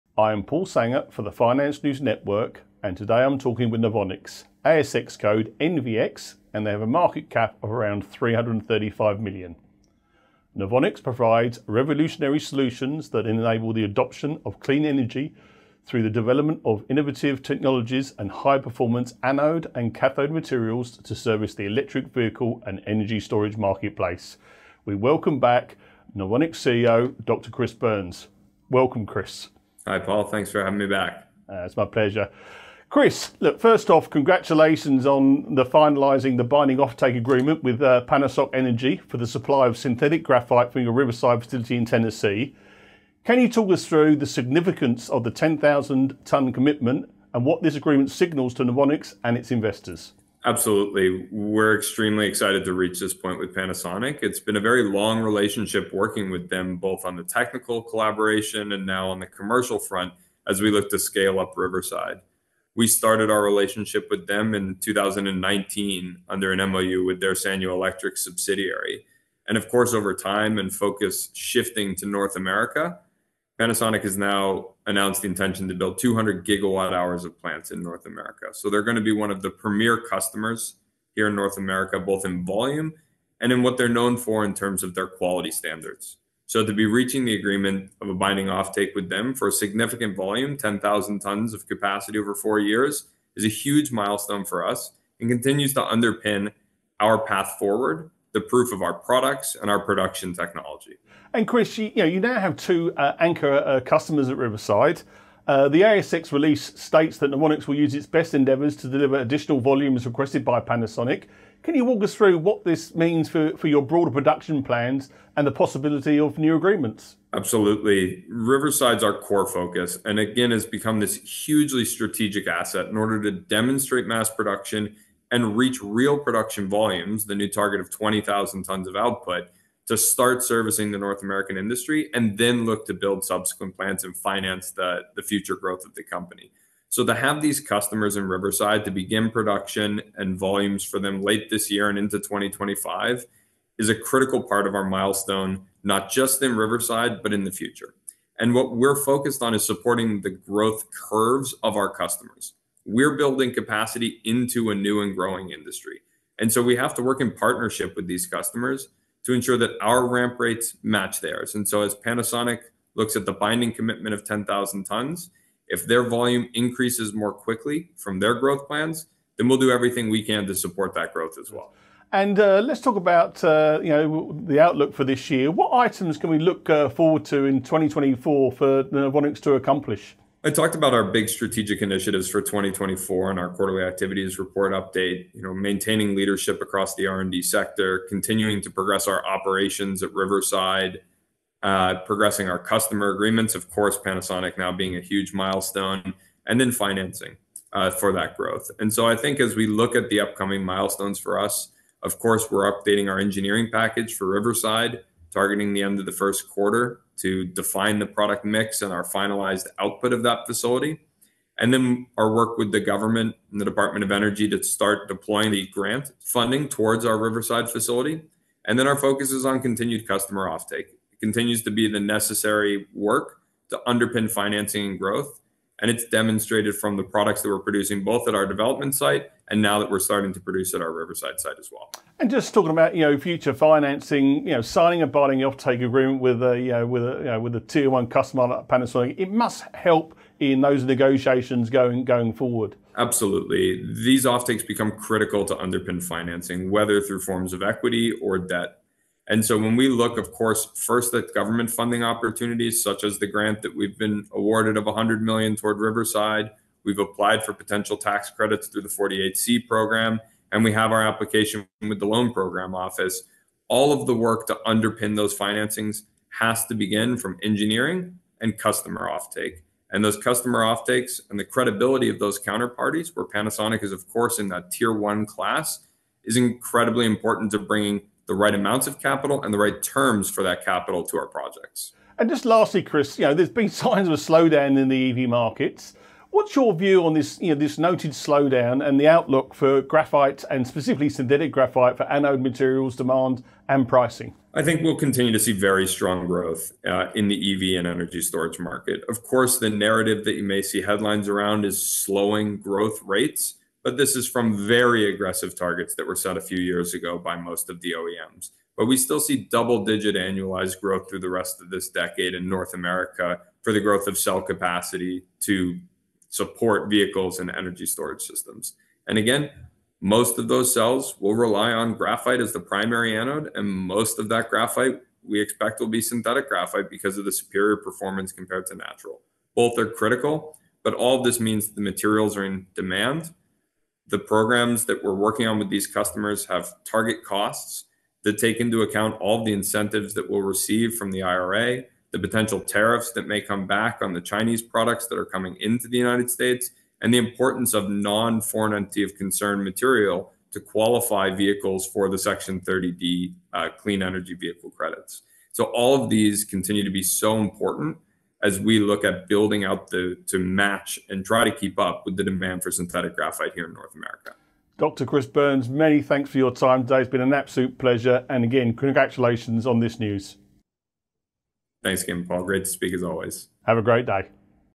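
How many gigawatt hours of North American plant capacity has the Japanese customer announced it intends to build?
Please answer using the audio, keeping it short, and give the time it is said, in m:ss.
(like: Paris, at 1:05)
200, at 1:15.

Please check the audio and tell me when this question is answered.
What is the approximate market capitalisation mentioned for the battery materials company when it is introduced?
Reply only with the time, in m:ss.
0:08.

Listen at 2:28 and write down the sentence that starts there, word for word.
And what we're focused on is supporting the growth curves of our customers we're building capacity into a new and growing industry.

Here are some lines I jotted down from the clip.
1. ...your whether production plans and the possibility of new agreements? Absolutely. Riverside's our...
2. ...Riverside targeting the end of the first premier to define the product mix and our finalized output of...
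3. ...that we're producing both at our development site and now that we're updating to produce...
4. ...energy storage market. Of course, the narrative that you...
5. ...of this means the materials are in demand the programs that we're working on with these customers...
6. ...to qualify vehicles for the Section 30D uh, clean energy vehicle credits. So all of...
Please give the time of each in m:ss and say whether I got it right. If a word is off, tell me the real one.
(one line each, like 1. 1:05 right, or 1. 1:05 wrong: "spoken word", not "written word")
1. 1:53 wrong: "broader", not "whether"
2. 3:24 wrong: "quarter", not "premier"
3. 3:47 wrong: "starting", not "updating"
4. 4:57 right
5. 5:31 right
6. 5:50 right.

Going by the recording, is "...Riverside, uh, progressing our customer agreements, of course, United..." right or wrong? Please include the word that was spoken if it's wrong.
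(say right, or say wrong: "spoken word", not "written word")
wrong: "Panasonic", not "United".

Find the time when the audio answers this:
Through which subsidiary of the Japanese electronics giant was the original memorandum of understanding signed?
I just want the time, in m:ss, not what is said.
1:07.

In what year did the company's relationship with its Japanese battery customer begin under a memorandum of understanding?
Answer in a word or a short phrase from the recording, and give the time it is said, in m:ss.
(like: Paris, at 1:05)
2019, at 1:04.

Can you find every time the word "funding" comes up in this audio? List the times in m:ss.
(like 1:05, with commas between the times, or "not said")
3:36, 4:11.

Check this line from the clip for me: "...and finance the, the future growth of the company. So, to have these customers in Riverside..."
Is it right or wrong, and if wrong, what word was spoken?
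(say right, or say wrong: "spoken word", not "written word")
right.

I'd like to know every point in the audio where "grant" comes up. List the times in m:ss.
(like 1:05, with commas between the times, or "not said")
3:35, 4:13.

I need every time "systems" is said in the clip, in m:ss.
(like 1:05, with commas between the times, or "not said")
5:18.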